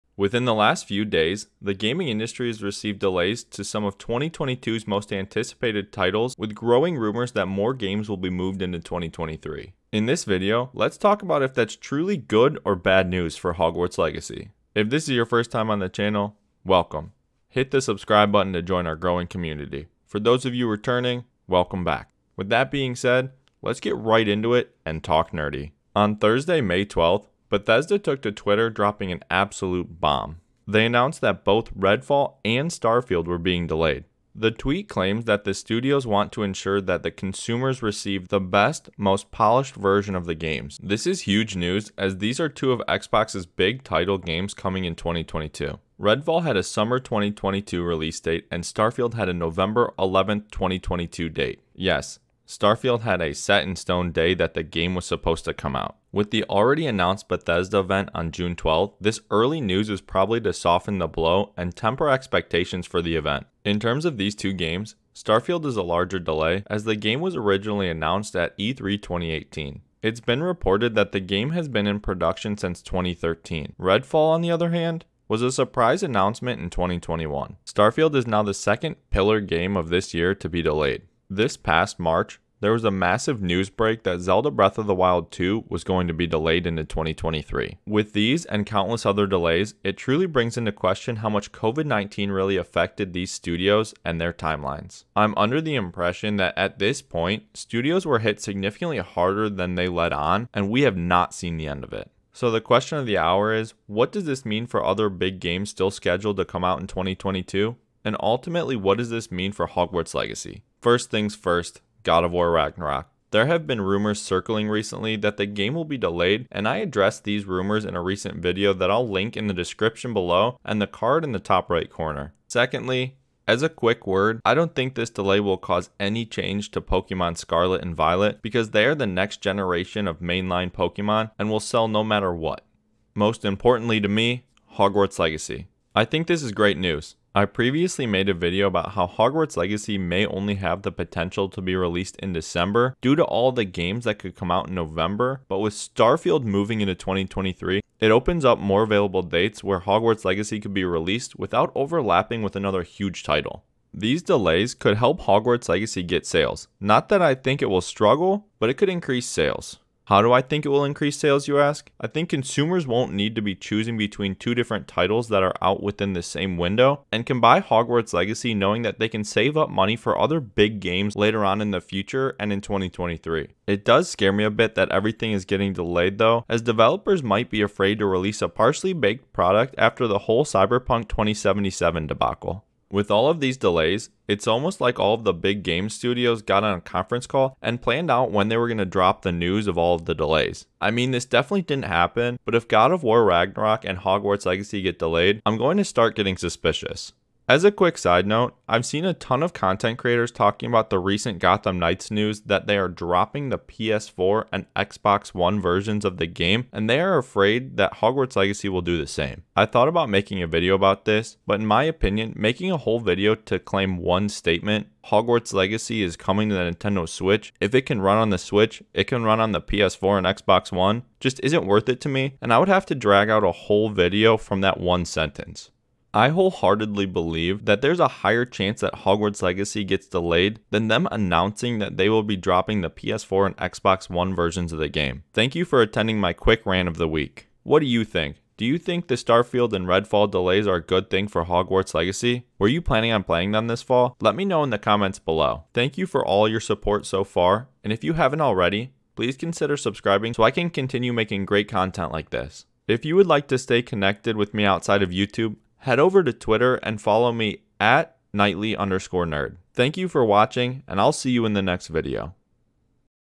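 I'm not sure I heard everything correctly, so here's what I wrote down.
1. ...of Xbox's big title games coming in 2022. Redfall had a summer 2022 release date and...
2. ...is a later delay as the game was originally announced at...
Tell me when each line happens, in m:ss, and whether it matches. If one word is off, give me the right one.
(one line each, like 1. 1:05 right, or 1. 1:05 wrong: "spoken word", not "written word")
1. 0:42 right
2. 1:05 wrong: "larger", not "later".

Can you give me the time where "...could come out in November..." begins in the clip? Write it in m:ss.
2:24.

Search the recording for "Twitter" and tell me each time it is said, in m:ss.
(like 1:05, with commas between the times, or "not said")
0:28, 4:16.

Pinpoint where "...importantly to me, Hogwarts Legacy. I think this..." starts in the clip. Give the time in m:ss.
2:13.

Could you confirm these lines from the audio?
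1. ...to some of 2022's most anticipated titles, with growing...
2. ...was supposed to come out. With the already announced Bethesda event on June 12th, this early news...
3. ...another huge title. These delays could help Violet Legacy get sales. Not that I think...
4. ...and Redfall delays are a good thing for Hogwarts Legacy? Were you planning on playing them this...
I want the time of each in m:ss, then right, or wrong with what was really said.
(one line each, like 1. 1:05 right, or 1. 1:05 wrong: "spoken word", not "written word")
1. 0:03 right
2. 0:54 right
3. 2:32 wrong: "Hogwarts", not "Violet"
4. 3:59 right.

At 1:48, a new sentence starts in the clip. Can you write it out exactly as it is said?
And ultimately, what does this mean for Hogwarts Legacy?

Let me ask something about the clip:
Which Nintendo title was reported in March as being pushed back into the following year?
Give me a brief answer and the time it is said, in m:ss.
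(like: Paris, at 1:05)
Zelda Breath of the Wild 2, at 1:24.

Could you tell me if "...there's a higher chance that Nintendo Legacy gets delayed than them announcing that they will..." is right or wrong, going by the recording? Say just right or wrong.
wrong.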